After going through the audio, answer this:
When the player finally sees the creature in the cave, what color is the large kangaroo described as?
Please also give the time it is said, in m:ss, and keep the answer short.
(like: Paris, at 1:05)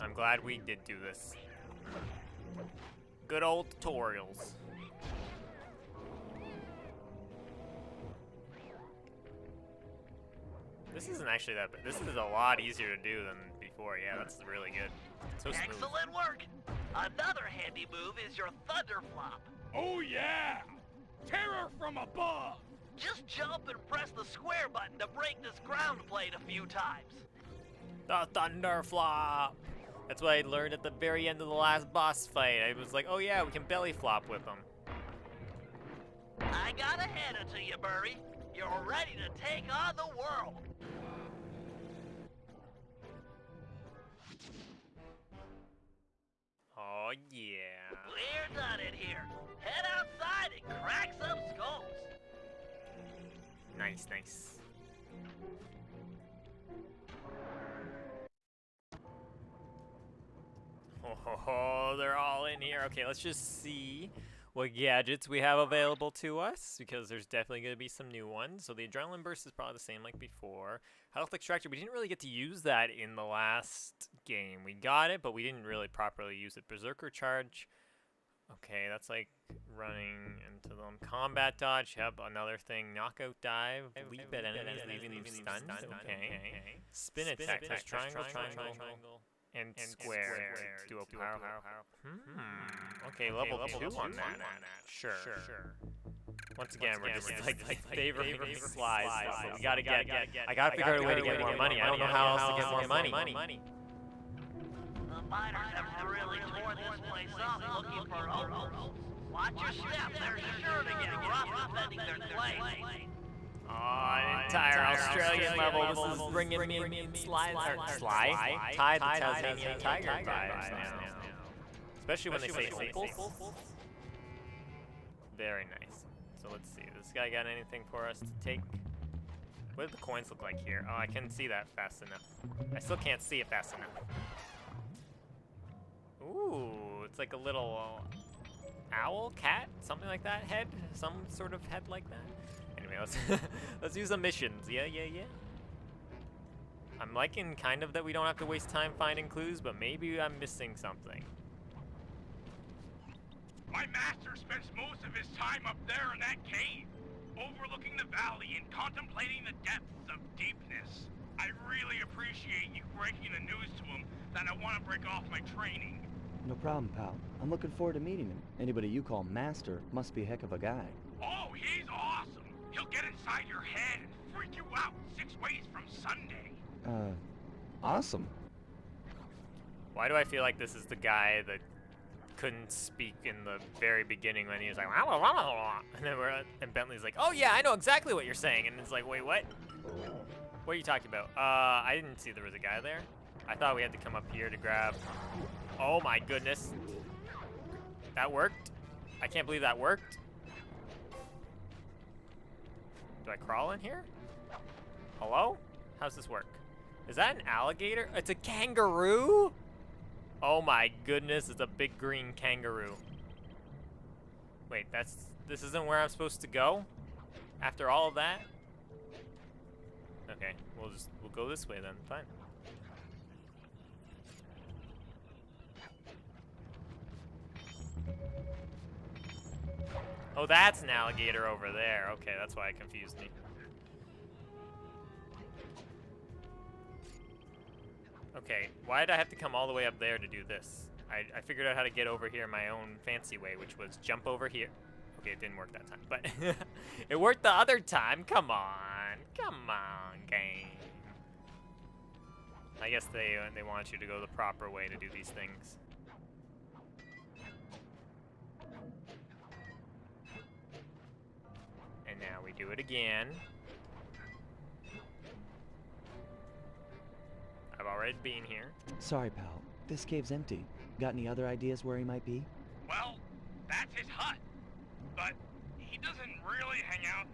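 Green, at 3:31.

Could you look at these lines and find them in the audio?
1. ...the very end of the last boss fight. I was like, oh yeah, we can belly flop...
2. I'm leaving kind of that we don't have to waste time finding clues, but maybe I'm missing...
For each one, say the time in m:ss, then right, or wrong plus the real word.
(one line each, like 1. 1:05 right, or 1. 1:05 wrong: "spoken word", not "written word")
1. 0:30 right
2. 2:26 wrong: "liking", not "leaving".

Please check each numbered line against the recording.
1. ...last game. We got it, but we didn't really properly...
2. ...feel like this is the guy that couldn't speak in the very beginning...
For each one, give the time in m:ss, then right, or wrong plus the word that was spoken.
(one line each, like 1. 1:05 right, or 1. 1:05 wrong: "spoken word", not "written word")
1. 1:13 right
2. 3:00 right.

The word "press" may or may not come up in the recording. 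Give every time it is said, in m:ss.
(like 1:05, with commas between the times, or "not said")
0:23, 1:27.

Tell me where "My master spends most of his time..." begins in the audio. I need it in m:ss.
2:33.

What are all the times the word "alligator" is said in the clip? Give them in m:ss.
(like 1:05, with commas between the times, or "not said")
3:27, 3:50.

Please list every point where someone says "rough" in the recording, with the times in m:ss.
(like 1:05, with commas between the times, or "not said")
1:51.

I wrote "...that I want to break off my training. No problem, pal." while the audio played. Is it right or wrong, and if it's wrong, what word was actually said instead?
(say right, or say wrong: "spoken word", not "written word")
right.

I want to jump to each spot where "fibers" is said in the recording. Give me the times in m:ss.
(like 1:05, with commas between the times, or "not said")
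not said.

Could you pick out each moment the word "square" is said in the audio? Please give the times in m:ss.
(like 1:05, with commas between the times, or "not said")
0:24, 1:29.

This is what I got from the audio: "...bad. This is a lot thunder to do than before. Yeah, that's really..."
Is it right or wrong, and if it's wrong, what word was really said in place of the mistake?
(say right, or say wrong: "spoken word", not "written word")
wrong: "easier", not "thunder".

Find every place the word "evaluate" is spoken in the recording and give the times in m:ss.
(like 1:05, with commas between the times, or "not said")
not said.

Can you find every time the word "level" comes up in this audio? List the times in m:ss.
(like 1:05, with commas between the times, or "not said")
1:33, 1:55.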